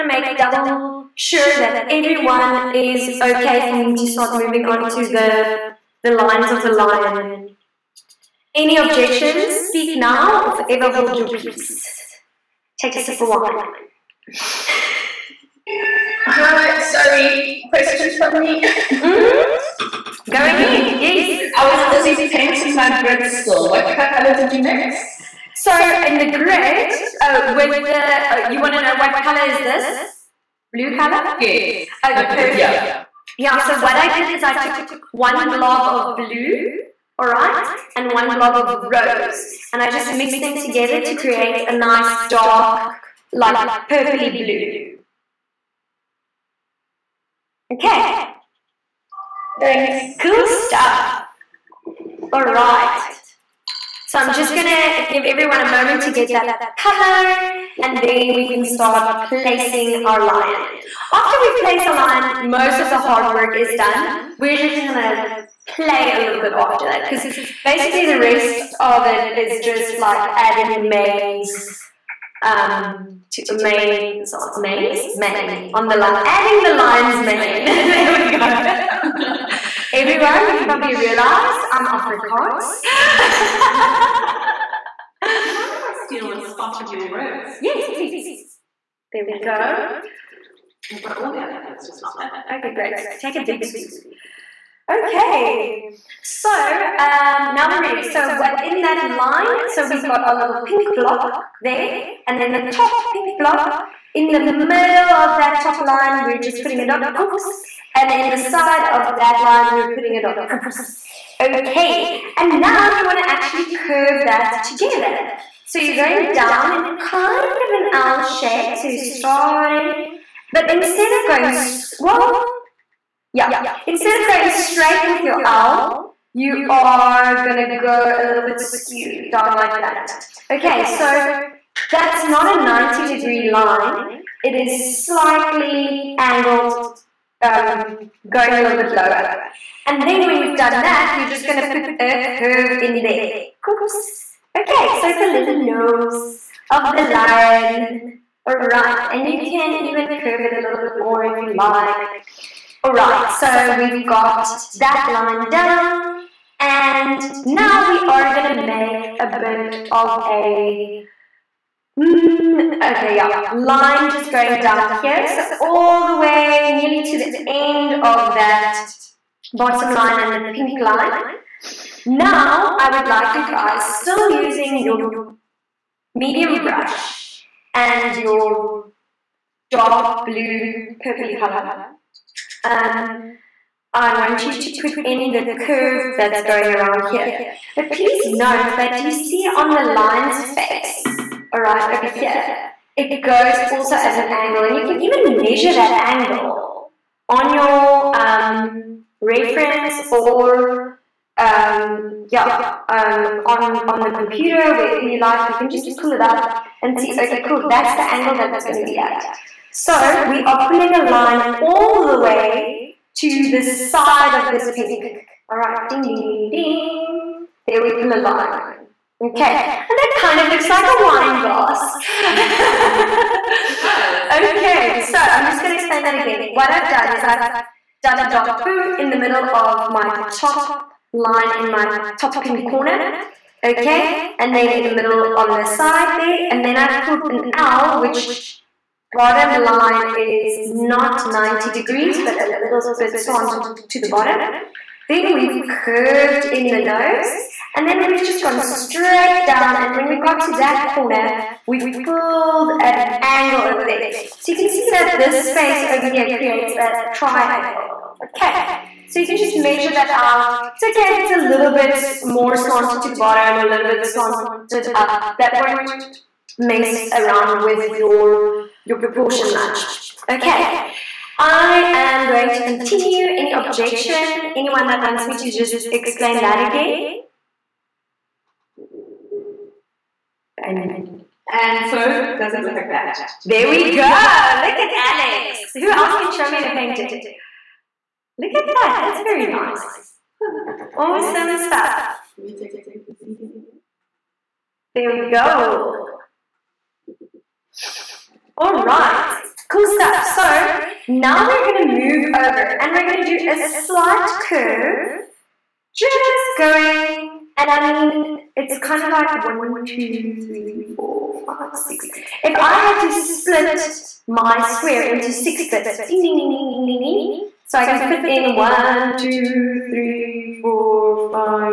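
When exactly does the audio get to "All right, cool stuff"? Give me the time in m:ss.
4:58.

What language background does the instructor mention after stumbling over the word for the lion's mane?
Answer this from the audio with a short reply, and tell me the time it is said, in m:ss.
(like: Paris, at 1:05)
Afrikaans, at 1:21.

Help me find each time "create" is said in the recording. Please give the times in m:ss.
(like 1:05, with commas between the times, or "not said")
0:41, 4:16.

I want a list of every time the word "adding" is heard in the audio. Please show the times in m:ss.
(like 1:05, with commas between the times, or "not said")
1:10, 1:16.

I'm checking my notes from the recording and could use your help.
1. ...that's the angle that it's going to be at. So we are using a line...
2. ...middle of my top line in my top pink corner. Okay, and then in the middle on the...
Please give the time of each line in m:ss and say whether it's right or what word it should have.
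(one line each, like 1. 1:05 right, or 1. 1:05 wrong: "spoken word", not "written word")
1. 3:27 wrong: "pulling", not "using"
2. 3:49 right.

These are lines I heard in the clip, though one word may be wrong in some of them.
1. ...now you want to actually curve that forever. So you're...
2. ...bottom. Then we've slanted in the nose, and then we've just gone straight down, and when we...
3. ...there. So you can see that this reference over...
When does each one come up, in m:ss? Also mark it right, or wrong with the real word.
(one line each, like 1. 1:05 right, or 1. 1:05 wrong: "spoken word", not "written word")
1. 1:52 wrong: "together", not "forever"
2. 4:04 wrong: "curved", not "slanted"
3. 4:13 wrong: "space", not "reference".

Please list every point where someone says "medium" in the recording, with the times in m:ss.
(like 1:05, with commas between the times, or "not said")
2:56.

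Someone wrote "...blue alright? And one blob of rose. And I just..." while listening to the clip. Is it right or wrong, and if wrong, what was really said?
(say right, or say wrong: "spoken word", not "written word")
right.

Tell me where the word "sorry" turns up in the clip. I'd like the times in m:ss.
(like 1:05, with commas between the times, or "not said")
0:16.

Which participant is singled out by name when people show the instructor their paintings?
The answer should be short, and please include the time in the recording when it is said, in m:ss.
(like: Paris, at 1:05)
Alex, at 4:44.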